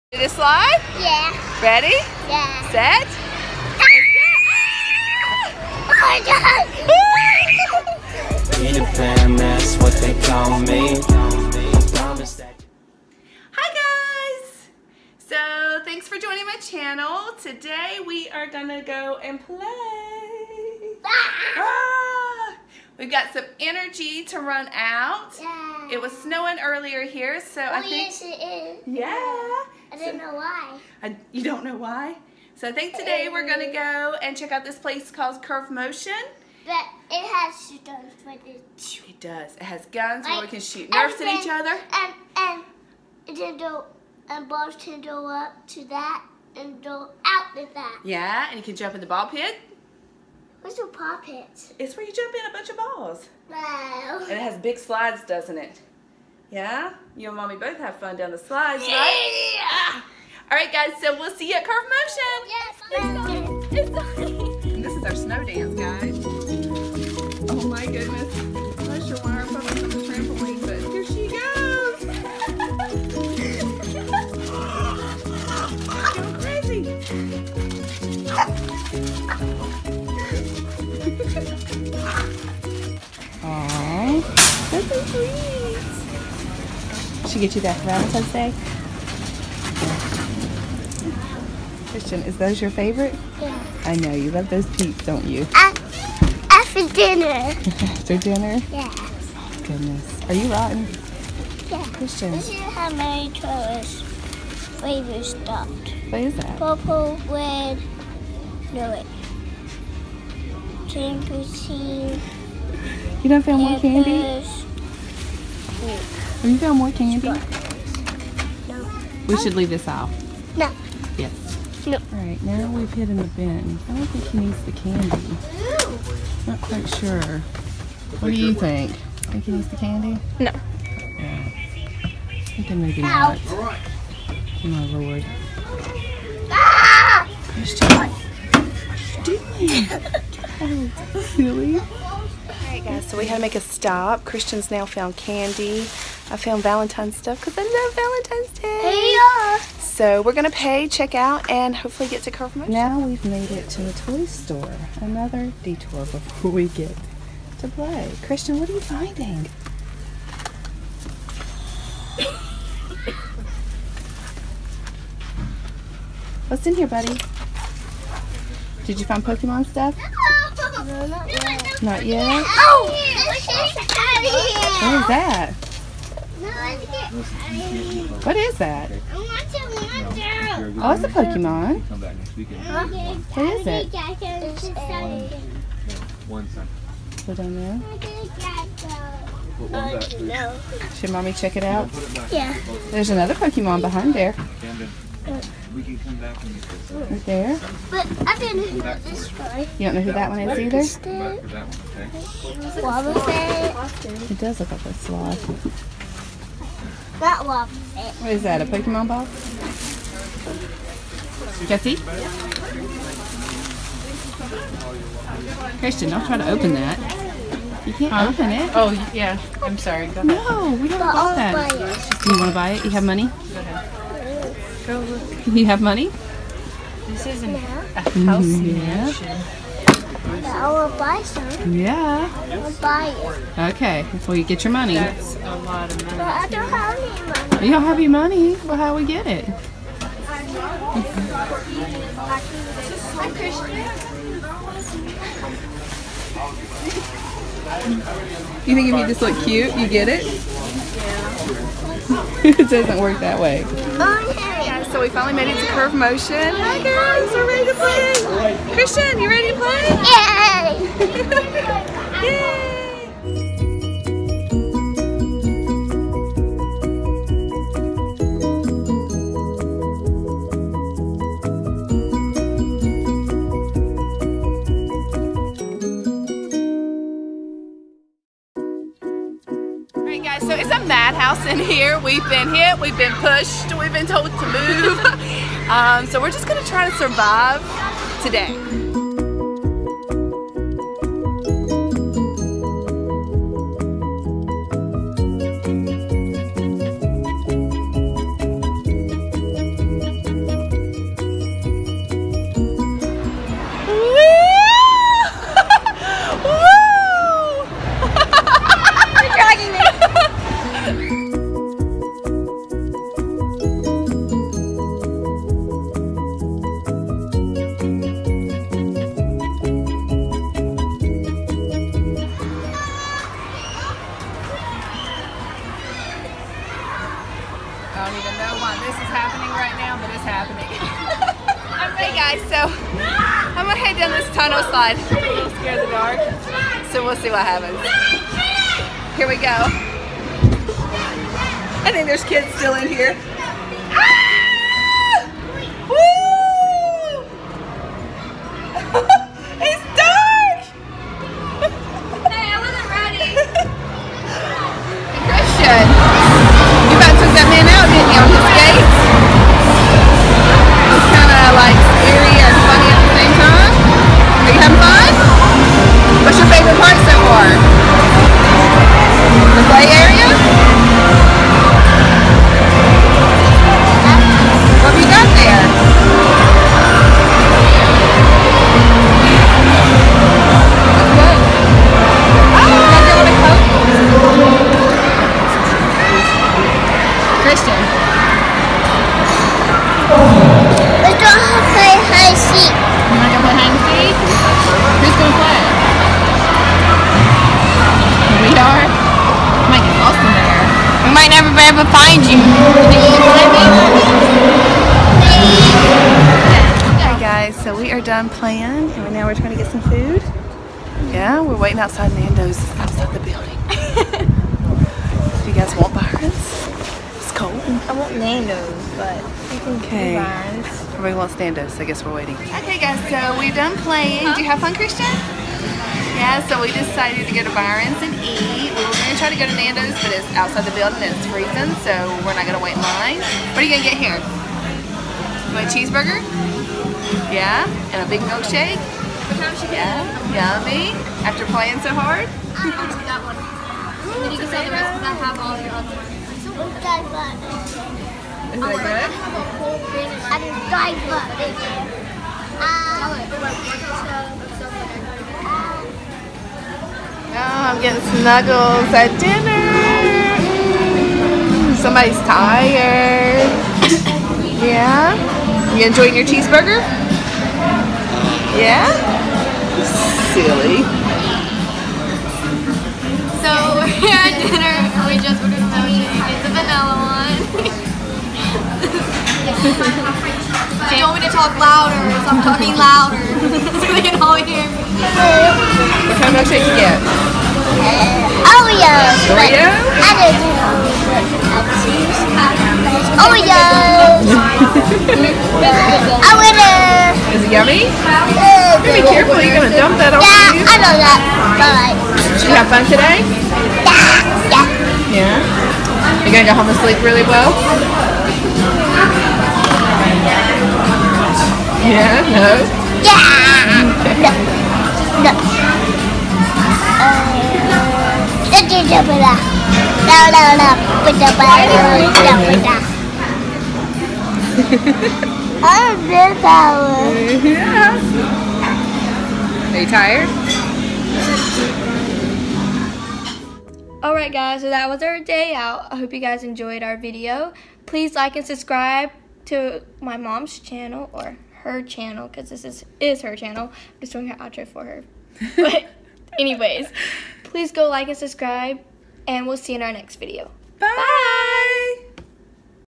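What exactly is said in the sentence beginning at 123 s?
I don't think he needs the candy.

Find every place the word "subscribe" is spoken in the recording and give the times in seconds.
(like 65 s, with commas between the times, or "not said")
538 s, 548 s.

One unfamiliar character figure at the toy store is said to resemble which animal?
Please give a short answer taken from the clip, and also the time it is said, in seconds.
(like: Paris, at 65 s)
A sloth, at 204 s.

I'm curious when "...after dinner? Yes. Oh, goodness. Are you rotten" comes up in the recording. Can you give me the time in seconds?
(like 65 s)
97 s.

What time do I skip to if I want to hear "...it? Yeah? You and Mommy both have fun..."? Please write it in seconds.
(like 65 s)
55 s.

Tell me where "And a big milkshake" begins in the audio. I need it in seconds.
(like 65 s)
437 s.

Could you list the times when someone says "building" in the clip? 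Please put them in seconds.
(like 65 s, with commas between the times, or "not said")
413 s, 430 s.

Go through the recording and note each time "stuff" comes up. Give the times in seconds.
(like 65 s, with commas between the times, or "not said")
147 s, 169 s.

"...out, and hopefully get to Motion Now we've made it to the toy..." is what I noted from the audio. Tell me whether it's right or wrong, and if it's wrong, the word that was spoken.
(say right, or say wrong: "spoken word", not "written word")
wrong: "Carver", not "Motion".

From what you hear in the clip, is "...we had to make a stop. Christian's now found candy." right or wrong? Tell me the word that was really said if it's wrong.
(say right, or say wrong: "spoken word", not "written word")
right.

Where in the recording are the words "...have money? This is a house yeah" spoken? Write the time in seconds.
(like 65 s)
225 s.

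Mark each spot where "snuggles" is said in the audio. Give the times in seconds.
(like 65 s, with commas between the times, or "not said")
458 s.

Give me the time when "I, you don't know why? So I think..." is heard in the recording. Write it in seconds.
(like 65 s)
31 s.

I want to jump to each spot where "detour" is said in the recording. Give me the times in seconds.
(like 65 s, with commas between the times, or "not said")
155 s.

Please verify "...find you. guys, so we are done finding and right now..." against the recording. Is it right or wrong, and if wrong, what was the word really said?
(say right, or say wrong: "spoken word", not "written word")
wrong: "playing", not "finding".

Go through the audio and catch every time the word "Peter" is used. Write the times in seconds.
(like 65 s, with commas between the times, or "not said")
3 s.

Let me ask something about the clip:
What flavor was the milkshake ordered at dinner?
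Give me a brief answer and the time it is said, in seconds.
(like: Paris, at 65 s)
Vanilla, at 476 s.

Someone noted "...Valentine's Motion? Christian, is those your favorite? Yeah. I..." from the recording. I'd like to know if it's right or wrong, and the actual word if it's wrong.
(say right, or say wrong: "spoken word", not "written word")
wrong: "Day", not "Motion".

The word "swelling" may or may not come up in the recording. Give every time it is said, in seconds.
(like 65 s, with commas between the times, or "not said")
not said.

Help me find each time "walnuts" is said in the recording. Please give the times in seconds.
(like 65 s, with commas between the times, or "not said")
not said.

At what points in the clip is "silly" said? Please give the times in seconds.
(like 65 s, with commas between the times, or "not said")
141 s, 470 s.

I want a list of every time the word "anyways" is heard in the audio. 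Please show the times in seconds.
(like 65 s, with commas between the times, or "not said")
546 s.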